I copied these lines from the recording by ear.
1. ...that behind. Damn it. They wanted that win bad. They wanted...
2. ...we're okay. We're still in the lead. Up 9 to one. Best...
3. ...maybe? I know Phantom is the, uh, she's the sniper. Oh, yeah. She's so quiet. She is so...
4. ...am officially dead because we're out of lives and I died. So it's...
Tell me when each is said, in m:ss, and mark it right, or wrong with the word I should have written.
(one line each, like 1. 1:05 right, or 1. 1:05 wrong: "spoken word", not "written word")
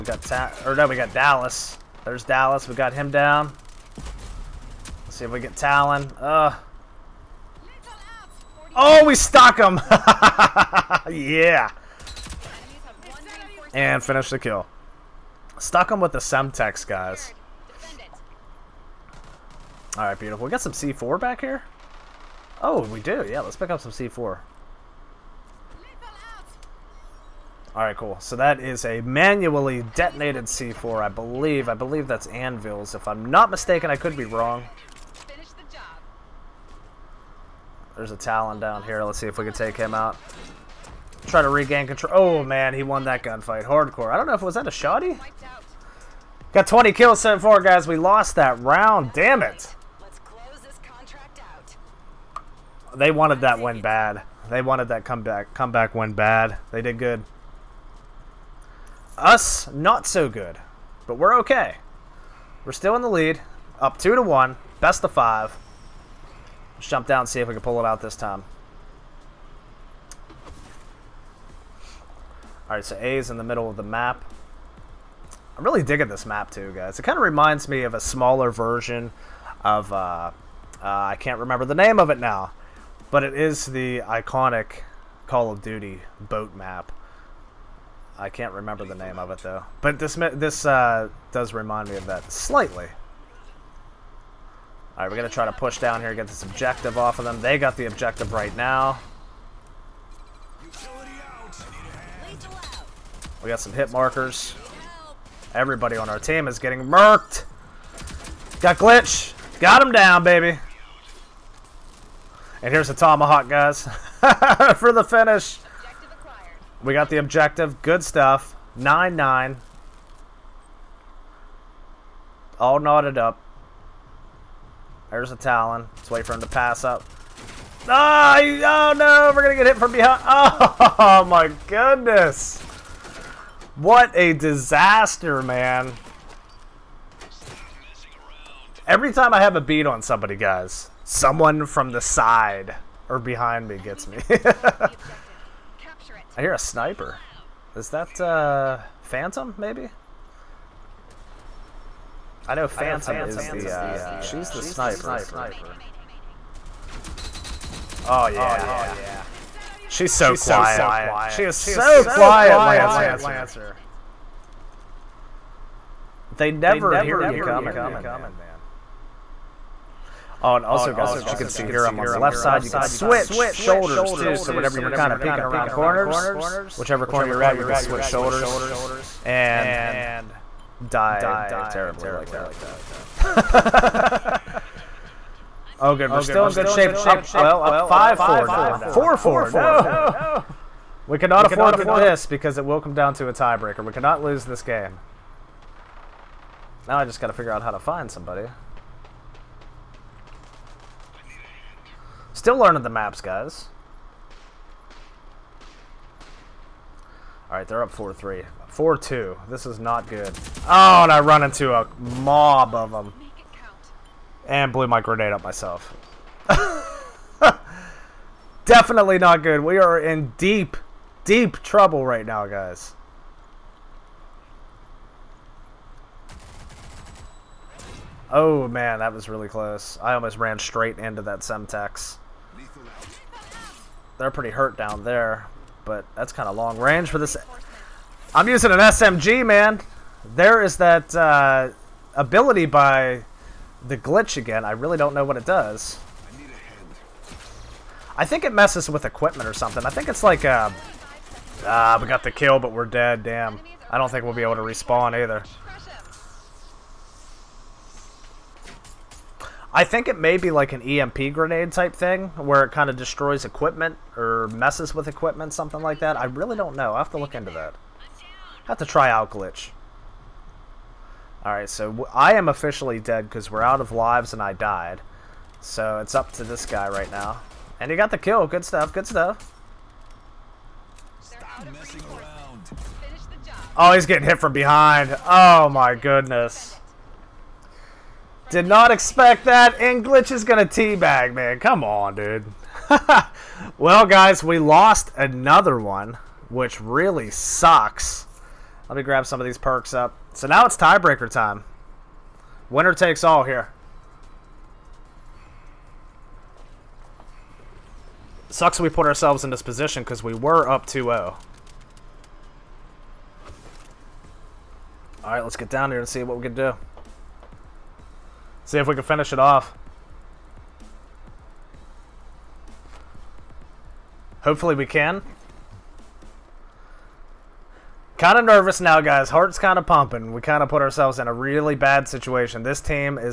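1. 0:48 wrong: "round", not "behind"
2. 1:01 wrong: "2", not "9"
3. 2:29 right
4. 4:32 right.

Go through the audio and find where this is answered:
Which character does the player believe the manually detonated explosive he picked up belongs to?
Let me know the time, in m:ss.
0:32.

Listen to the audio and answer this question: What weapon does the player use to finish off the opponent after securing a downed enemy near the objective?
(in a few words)
Tomahawk.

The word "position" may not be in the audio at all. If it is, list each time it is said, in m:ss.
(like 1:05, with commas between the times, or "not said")
5:09.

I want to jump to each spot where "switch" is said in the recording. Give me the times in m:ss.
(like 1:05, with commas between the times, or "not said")
2:52, 2:57.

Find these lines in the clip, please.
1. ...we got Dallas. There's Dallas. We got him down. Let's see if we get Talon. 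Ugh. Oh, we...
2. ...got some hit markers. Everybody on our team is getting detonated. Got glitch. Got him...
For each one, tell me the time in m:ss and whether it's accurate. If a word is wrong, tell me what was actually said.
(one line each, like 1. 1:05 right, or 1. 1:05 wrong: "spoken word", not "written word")
1. 0:00 right
2. 1:43 wrong: "murked", not "detonated".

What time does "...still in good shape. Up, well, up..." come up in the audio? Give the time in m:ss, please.
3:06.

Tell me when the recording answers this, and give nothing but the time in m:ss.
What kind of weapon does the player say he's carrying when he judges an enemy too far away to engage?
3:58.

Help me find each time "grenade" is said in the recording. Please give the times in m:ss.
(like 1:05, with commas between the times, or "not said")
3:34, 4:21.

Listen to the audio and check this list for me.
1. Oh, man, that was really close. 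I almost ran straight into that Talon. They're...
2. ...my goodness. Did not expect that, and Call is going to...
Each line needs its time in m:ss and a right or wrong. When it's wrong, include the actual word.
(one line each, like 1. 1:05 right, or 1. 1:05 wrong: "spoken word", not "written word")
1. 3:48 wrong: "Semtex", not "Talon"
2. 4:45 wrong: "Glitch", not "Call".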